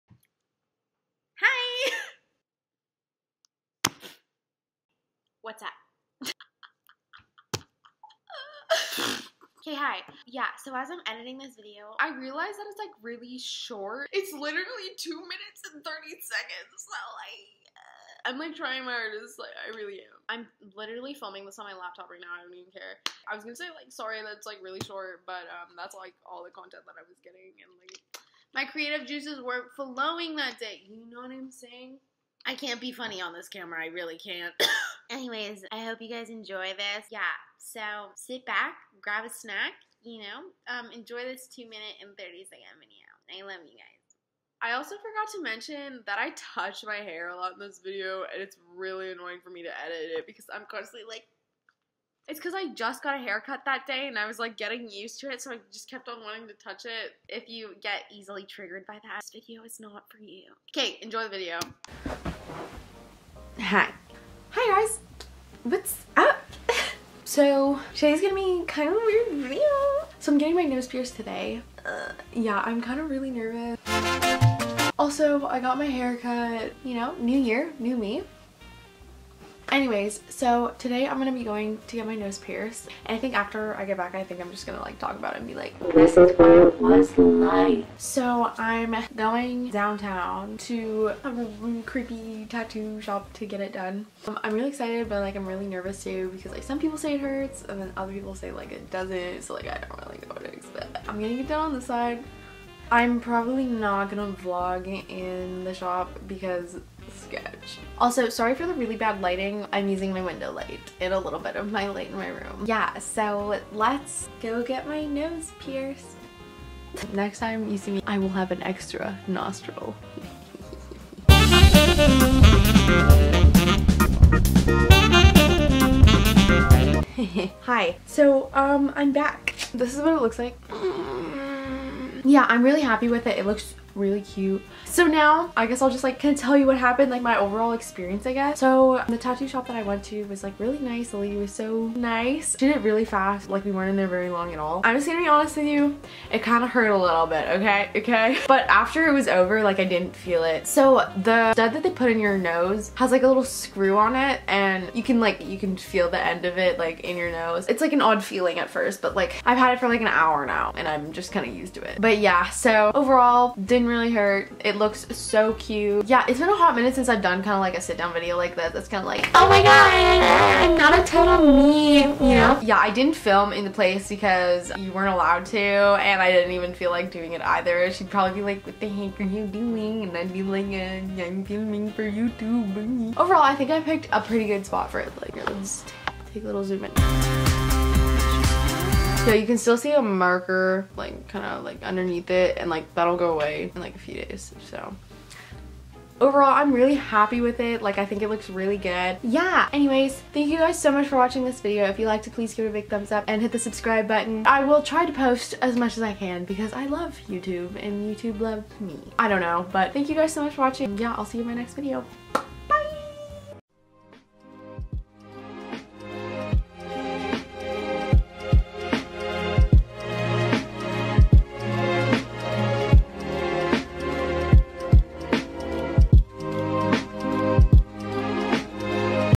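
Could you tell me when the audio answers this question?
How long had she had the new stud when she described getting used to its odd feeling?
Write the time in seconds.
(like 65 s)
160 s.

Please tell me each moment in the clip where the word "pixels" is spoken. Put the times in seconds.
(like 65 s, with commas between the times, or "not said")
not said.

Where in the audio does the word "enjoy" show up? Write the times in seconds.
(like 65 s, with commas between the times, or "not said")
36 s, 40 s, 61 s.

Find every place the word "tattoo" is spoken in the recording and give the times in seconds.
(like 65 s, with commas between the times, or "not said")
92 s, 139 s.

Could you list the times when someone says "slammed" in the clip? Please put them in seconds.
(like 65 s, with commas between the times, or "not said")
not said.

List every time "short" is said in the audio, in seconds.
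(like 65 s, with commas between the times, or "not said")
13 s, 24 s.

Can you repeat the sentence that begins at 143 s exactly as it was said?
Like we weren't in there very long at all.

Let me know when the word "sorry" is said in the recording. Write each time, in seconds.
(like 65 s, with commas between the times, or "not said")
23 s, 108 s.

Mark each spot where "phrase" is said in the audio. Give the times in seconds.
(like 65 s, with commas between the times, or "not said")
not said.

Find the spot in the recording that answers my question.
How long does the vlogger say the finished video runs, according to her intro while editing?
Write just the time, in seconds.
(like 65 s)
15 s.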